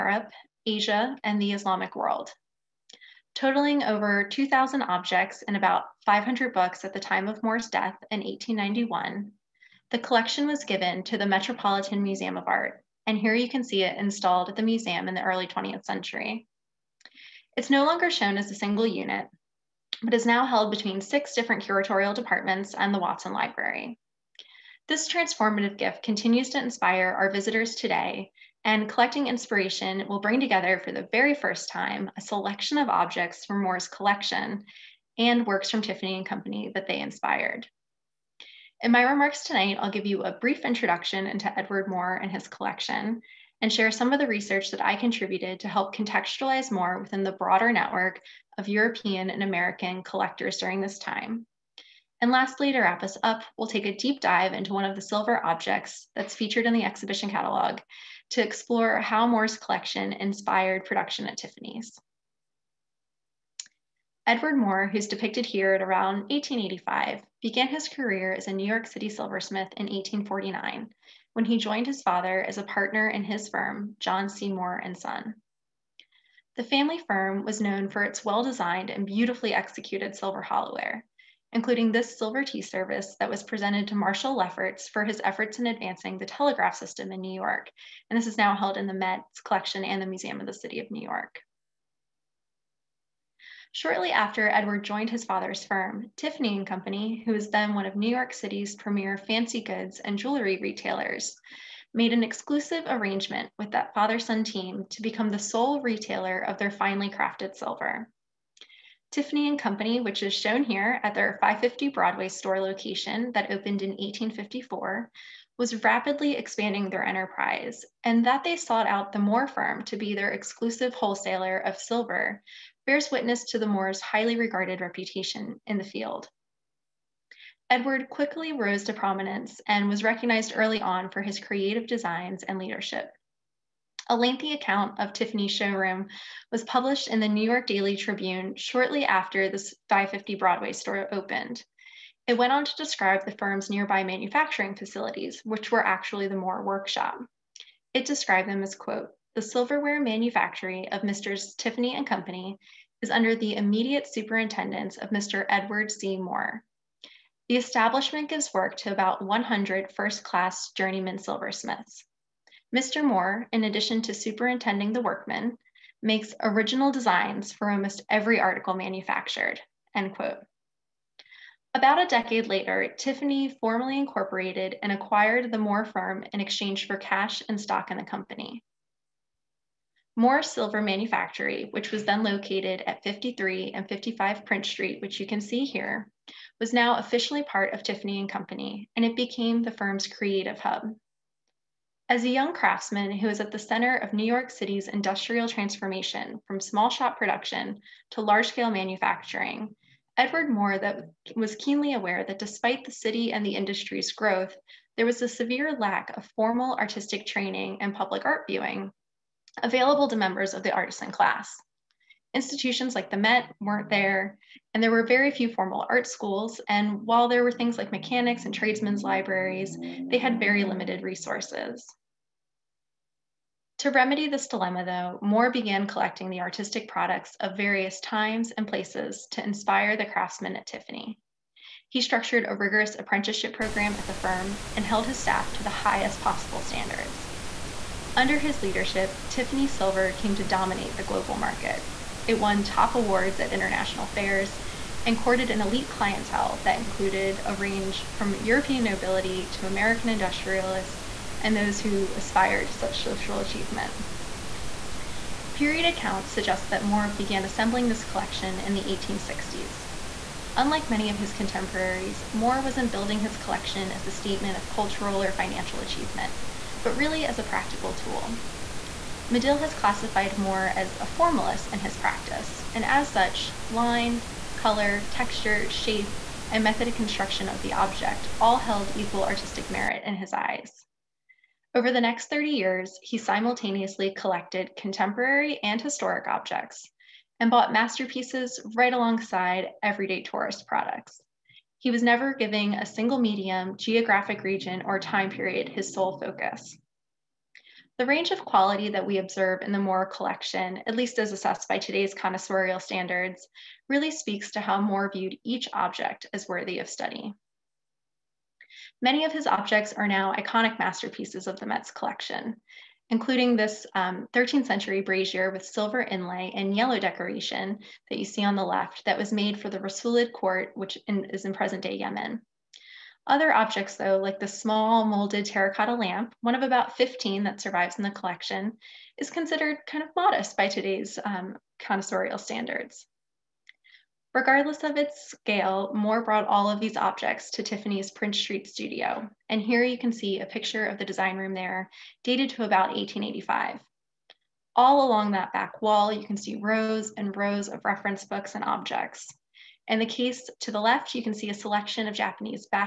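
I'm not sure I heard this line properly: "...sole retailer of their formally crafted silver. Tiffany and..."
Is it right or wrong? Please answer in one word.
wrong.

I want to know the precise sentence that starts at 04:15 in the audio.
Period accounts suggest that Moore began assembling this collection in the 1860s.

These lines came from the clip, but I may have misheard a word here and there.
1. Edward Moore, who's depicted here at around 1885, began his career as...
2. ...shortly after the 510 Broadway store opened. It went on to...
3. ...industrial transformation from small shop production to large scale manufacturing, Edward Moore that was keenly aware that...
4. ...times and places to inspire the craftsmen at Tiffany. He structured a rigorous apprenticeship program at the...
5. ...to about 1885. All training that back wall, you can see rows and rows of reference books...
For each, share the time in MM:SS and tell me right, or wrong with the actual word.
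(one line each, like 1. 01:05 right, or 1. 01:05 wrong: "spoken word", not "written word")
1. 01:04 right
2. 02:18 wrong: "550", not "510"
3. 03:14 right
4. 03:48 right
5. 05:42 wrong: "along", not "training".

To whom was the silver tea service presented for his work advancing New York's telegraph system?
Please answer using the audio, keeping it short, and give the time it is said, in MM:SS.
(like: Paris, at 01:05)
Marshall Lefferts, at 01:23.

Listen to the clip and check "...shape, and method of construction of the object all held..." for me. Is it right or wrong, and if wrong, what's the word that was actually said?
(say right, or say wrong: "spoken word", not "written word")
right.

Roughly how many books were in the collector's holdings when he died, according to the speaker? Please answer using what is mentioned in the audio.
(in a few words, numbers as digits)
500.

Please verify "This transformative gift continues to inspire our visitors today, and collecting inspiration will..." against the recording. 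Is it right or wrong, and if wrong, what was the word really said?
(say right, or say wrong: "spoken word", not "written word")
right.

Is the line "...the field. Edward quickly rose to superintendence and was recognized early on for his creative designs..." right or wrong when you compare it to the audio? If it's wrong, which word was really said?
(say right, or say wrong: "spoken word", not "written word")
wrong: "prominence", not "superintendence".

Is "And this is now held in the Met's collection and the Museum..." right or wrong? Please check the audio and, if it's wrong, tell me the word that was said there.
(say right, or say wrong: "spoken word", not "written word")
right.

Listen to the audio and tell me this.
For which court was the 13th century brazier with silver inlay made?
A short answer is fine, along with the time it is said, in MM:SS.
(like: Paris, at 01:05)
Rasulid court, at 05:19.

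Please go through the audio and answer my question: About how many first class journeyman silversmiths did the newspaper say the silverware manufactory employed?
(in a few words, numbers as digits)
100.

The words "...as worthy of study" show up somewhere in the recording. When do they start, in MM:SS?
05:06.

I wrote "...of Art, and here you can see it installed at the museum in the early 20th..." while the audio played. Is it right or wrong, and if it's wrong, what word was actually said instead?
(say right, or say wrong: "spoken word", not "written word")
right.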